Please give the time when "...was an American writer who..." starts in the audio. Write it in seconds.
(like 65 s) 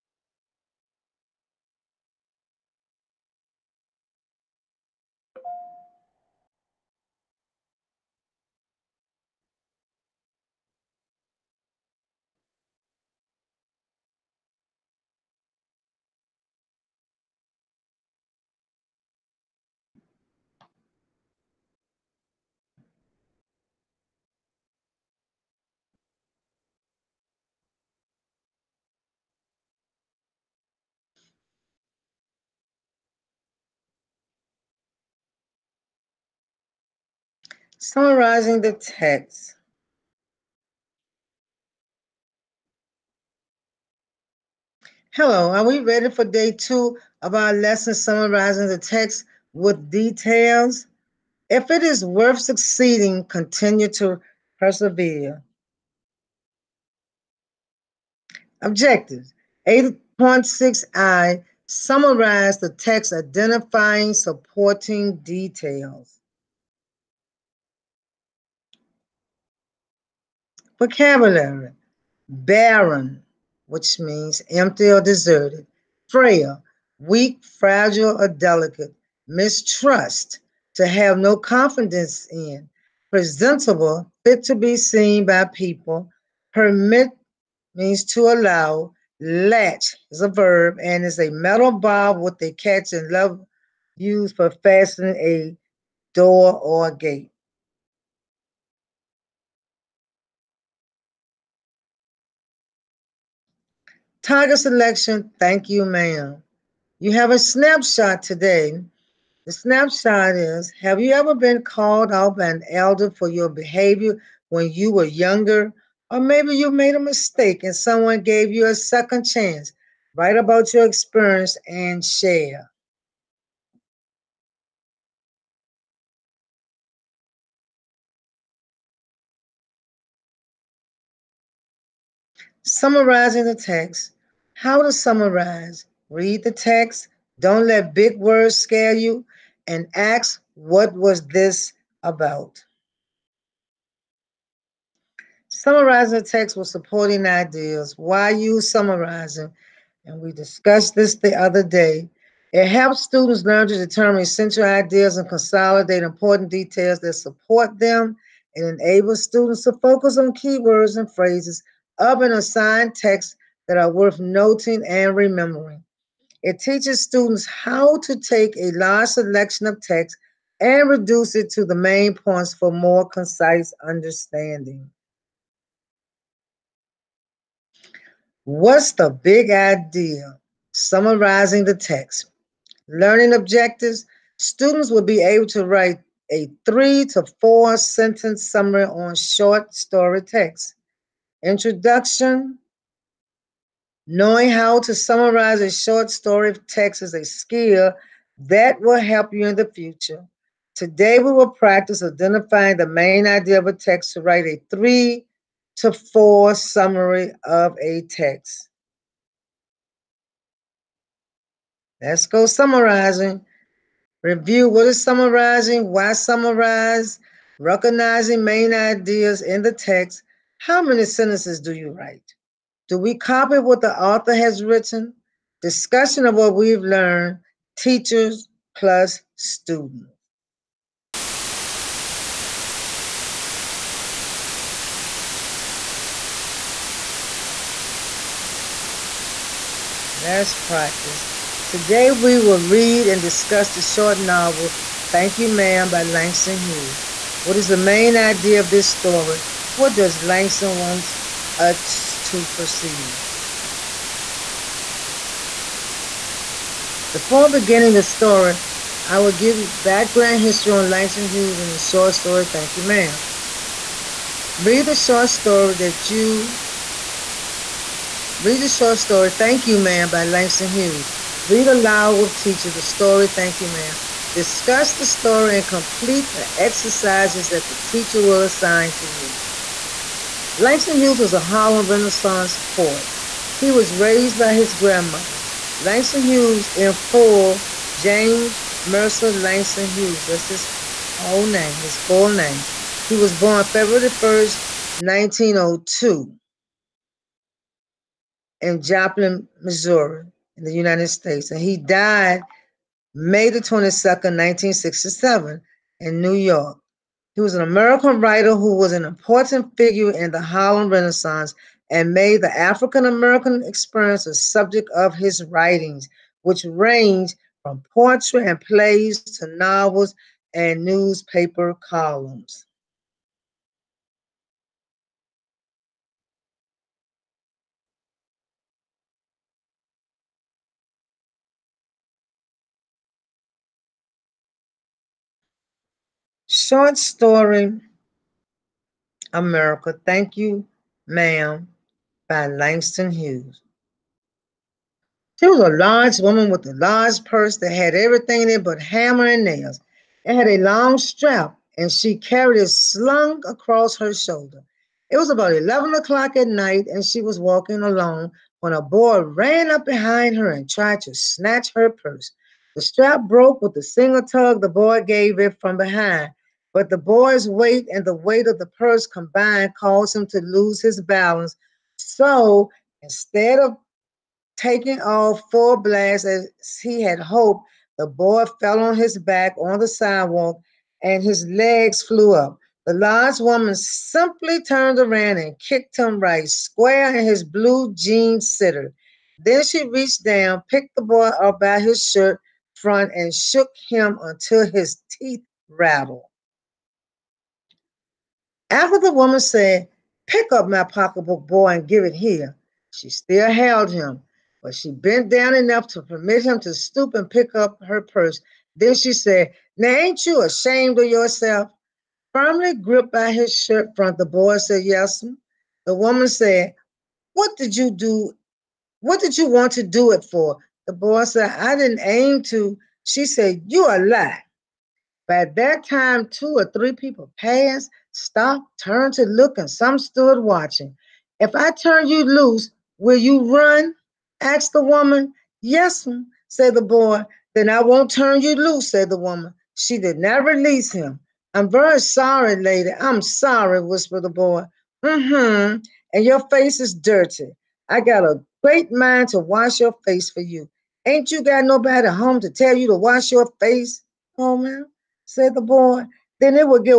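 307 s.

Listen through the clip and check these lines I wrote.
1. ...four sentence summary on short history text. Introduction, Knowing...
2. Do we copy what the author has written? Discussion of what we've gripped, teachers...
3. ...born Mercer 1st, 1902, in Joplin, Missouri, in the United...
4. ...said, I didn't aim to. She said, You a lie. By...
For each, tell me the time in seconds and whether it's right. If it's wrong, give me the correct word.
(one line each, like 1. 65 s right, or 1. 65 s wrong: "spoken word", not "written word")
1. 187 s wrong: "story", not "history"
2. 222 s wrong: "learned", not "gripped"
3. 293 s wrong: "February", not "Mercer"
4. 421 s right.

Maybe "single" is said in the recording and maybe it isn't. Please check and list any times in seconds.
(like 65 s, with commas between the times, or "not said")
363 s.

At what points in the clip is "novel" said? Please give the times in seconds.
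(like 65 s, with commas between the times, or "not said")
244 s, 319 s.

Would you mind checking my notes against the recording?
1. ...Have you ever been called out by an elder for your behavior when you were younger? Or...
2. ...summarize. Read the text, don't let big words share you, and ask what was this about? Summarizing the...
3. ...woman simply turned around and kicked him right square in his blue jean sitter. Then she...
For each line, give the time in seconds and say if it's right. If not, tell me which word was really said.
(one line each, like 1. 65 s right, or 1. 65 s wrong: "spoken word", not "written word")
1. 110 s right
2. 134 s wrong: "scare", not "share"
3. 383 s right.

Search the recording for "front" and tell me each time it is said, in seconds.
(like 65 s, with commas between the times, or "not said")
392 s, 413 s.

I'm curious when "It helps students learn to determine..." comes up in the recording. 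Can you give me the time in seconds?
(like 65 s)
152 s.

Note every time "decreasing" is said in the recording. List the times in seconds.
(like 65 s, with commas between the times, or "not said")
not said.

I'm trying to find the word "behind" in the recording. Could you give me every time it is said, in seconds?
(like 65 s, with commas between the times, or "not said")
359 s, 365 s.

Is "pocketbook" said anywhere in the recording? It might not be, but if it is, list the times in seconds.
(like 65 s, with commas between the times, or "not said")
400 s.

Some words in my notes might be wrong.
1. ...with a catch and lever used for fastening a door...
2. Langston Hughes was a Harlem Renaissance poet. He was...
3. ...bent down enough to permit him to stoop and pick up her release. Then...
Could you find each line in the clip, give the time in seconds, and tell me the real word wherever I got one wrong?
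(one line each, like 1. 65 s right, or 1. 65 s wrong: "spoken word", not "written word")
1. 92 s right
2. 280 s right
3. 404 s wrong: "purse", not "release".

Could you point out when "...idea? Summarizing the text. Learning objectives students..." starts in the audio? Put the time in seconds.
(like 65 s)
179 s.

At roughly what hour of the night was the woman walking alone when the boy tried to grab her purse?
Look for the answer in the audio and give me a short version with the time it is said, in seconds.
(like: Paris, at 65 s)
11 o'clock, at 355 s.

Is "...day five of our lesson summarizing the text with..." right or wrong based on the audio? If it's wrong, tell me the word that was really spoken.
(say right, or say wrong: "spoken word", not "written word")
wrong: "two", not "five".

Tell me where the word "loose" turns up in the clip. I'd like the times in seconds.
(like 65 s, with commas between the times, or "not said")
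432 s, 438 s.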